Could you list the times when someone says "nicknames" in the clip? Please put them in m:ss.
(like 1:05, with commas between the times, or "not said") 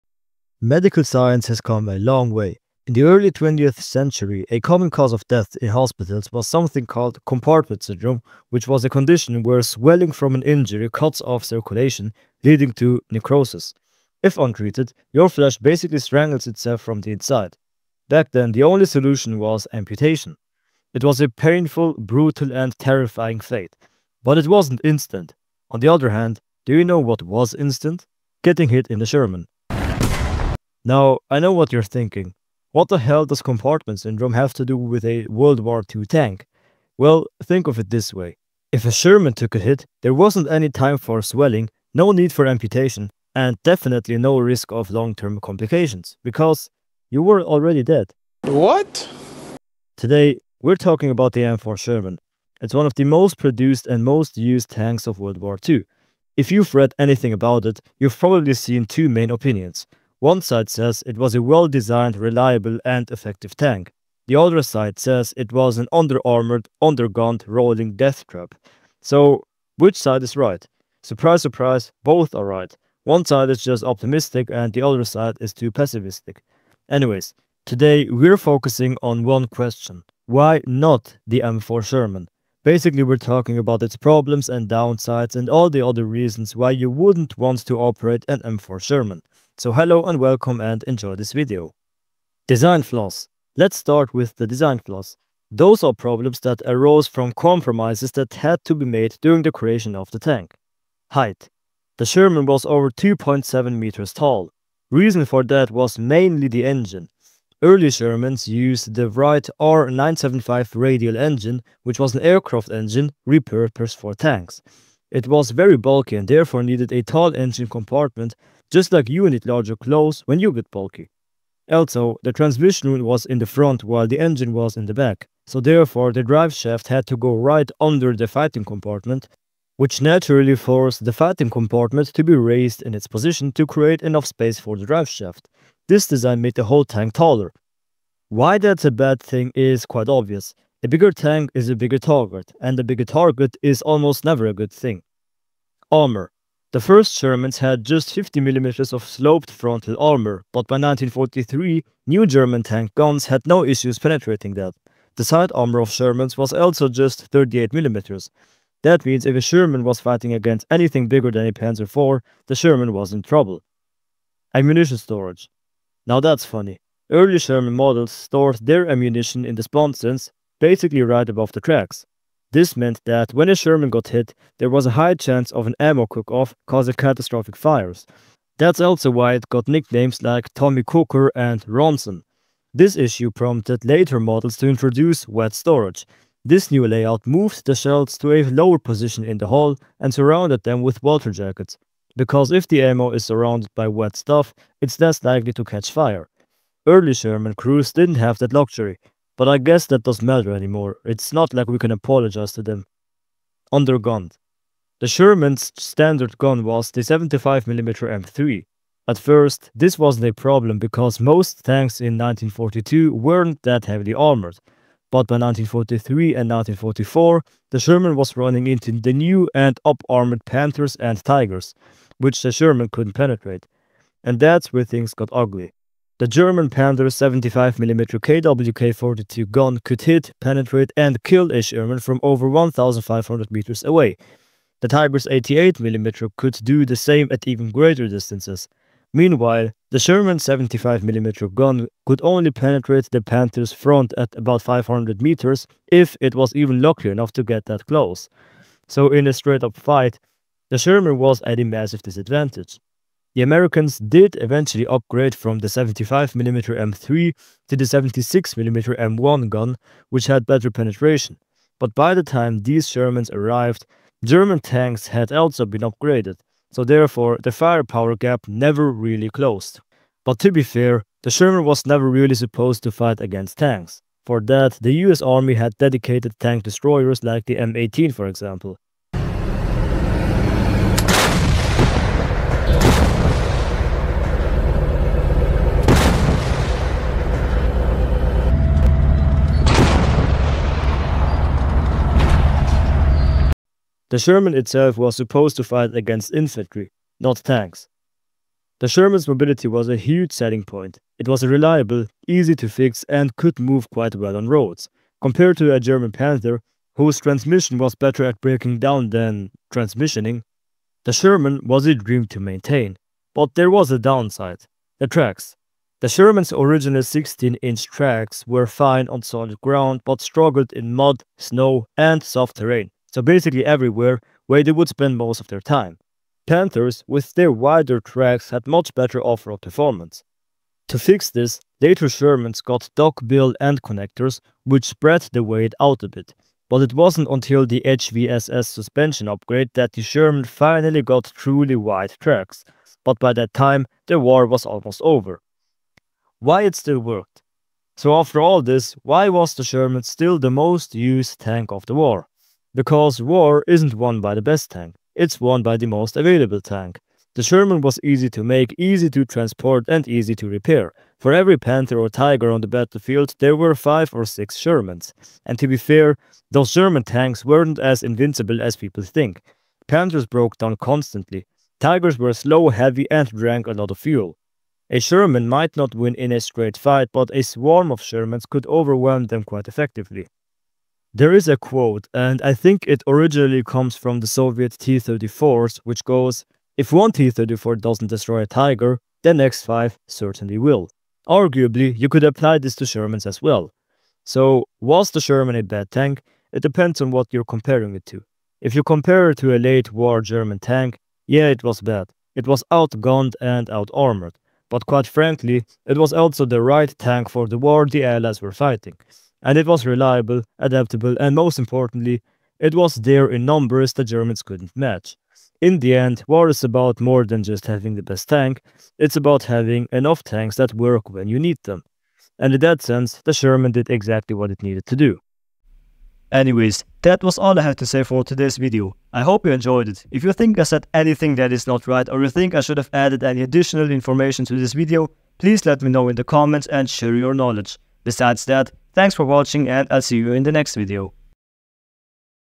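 2:59.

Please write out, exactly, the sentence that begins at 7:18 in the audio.
Besides that, Thanks for watching and I'll see you in the next video.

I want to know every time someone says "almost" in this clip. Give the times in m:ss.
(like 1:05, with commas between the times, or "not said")
2:23, 5:44.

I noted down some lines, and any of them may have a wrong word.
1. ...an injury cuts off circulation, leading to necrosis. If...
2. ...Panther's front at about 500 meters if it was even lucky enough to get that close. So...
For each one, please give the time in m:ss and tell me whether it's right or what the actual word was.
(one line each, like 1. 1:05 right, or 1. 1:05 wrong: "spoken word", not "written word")
1. 0:10 right
2. 4:03 right.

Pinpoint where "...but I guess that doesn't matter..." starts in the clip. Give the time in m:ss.
3:19.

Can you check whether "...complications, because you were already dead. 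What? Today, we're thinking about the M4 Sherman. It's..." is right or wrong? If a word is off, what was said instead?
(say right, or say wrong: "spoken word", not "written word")
wrong: "talking", not "thinking".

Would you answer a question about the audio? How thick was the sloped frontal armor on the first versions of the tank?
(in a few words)
50mm.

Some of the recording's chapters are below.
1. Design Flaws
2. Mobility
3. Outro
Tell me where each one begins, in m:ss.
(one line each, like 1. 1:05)
1. 1:32
2. 4:58
3. 7:05.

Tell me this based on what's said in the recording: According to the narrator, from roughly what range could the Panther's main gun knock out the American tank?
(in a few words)
1,500 meters.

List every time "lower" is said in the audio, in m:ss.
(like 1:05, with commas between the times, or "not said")
3:08.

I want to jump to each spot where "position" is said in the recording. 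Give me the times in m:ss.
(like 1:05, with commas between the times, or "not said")
2:13, 3:08.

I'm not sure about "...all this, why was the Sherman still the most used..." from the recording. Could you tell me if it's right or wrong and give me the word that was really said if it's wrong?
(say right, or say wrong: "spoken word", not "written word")
right.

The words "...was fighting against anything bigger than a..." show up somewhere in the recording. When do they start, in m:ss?
2:39.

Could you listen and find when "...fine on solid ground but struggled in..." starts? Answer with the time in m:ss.
5:18.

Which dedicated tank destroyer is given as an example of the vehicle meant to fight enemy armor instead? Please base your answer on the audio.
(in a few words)
M18.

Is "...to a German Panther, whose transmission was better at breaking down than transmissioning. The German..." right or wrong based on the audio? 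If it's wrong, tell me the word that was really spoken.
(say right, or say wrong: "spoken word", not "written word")
wrong: "Sherman", not "German".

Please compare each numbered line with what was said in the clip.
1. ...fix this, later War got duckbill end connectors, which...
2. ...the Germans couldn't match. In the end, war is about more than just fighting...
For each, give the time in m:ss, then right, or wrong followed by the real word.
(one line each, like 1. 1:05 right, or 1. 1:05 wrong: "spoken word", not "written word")
1. 5:30 wrong: "Shermans", not "War"
2. 6:53 wrong: "having", not "fighting".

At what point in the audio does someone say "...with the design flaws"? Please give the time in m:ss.
1:34.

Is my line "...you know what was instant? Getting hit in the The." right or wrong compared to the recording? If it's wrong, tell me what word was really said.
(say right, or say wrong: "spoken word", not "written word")
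wrong: "Sherman", not "The".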